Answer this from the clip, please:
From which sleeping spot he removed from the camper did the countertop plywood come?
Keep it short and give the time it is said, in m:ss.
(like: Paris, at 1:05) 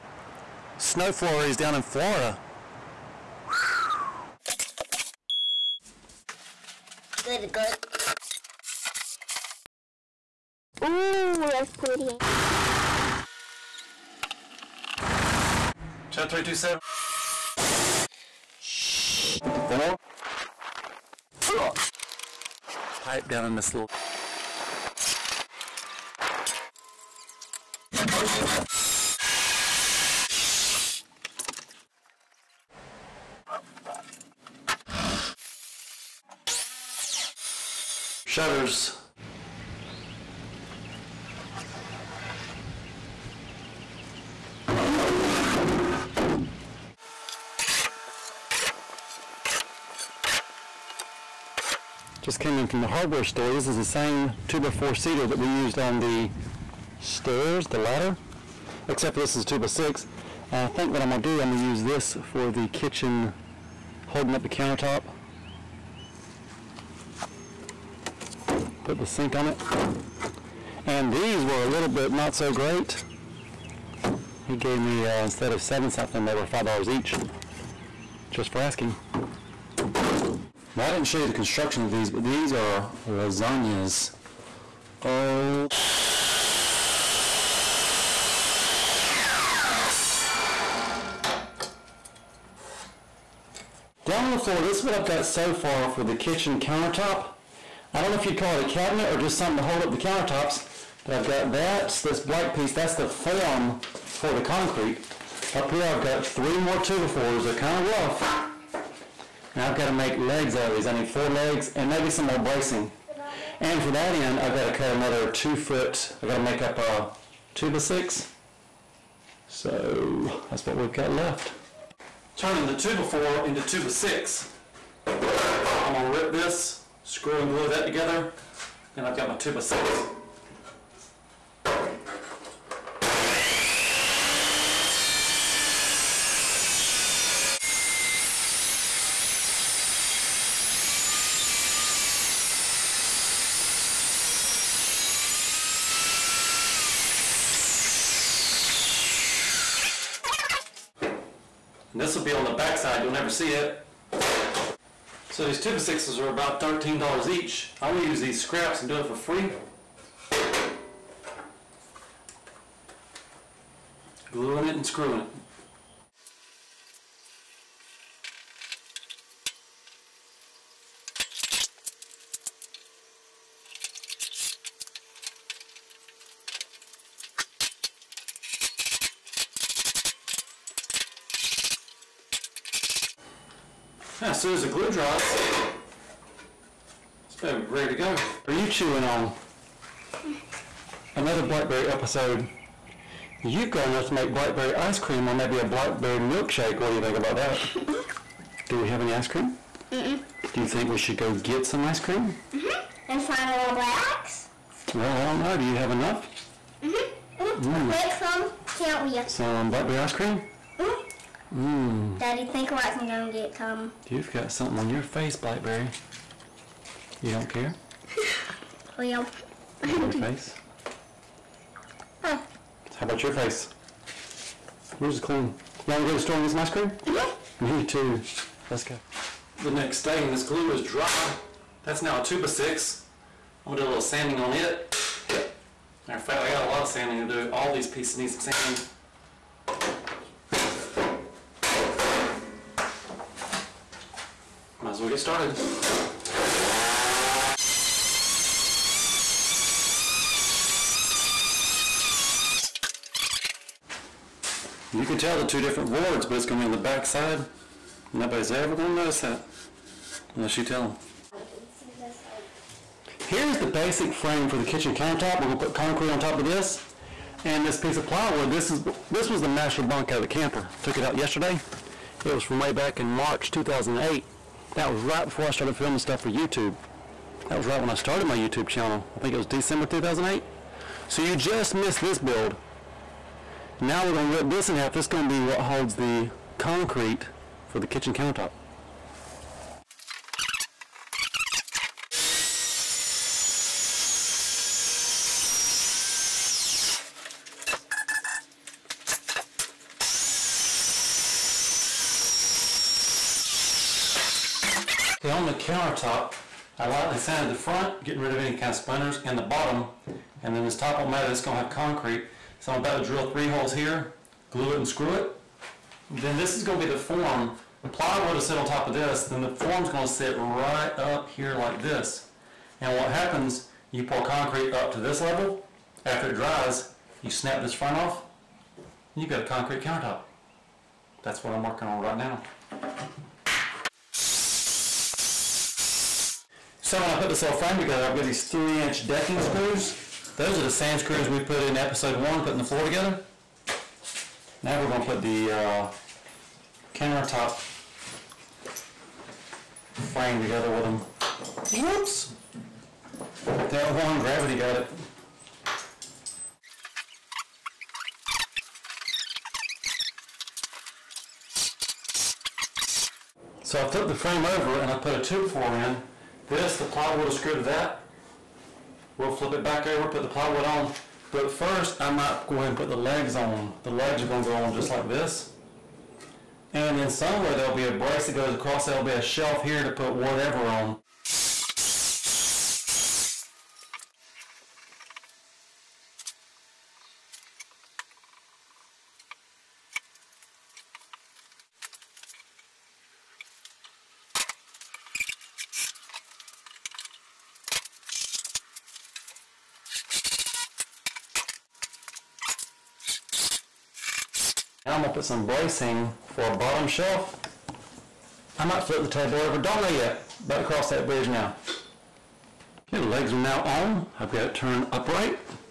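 Master bunk, at 4:29.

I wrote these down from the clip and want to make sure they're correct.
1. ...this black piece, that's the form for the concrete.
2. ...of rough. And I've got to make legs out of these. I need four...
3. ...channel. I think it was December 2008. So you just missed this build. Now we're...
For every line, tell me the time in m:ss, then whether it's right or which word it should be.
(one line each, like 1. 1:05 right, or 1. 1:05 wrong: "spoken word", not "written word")
1. 1:42 right
2. 1:47 right
3. 4:38 right.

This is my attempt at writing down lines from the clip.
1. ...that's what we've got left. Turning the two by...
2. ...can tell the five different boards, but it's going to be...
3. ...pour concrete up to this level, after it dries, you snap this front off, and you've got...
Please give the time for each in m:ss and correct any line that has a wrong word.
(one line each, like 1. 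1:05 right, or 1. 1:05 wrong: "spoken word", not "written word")
1. 2:00 right
2. 4:15 wrong: "two", not "five"
3. 5:24 right.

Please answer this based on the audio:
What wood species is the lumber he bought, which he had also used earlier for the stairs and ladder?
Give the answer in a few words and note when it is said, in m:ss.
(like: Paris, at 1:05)
Cedar, at 0:54.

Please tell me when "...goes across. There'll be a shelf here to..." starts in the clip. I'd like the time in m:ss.
6:18.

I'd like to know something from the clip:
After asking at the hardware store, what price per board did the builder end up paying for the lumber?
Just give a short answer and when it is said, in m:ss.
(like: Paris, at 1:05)
$5, at 1:16.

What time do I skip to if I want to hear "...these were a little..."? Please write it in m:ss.
1:11.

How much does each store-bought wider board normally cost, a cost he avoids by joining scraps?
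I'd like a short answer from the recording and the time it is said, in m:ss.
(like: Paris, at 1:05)
$13, at 2:36.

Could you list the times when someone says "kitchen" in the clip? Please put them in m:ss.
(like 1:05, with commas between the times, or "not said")
1:02, 1:36, 4:24, 4:47.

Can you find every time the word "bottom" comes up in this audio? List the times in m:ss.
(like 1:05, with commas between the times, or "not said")
5:09, 6:46.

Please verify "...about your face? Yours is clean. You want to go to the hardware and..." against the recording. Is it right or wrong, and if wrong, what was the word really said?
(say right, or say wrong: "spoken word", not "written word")
wrong: "store", not "hardware".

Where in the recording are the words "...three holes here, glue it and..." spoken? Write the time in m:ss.
5:13.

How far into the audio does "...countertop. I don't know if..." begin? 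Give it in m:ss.
1:36.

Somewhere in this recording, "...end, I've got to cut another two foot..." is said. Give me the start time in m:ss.
1:54.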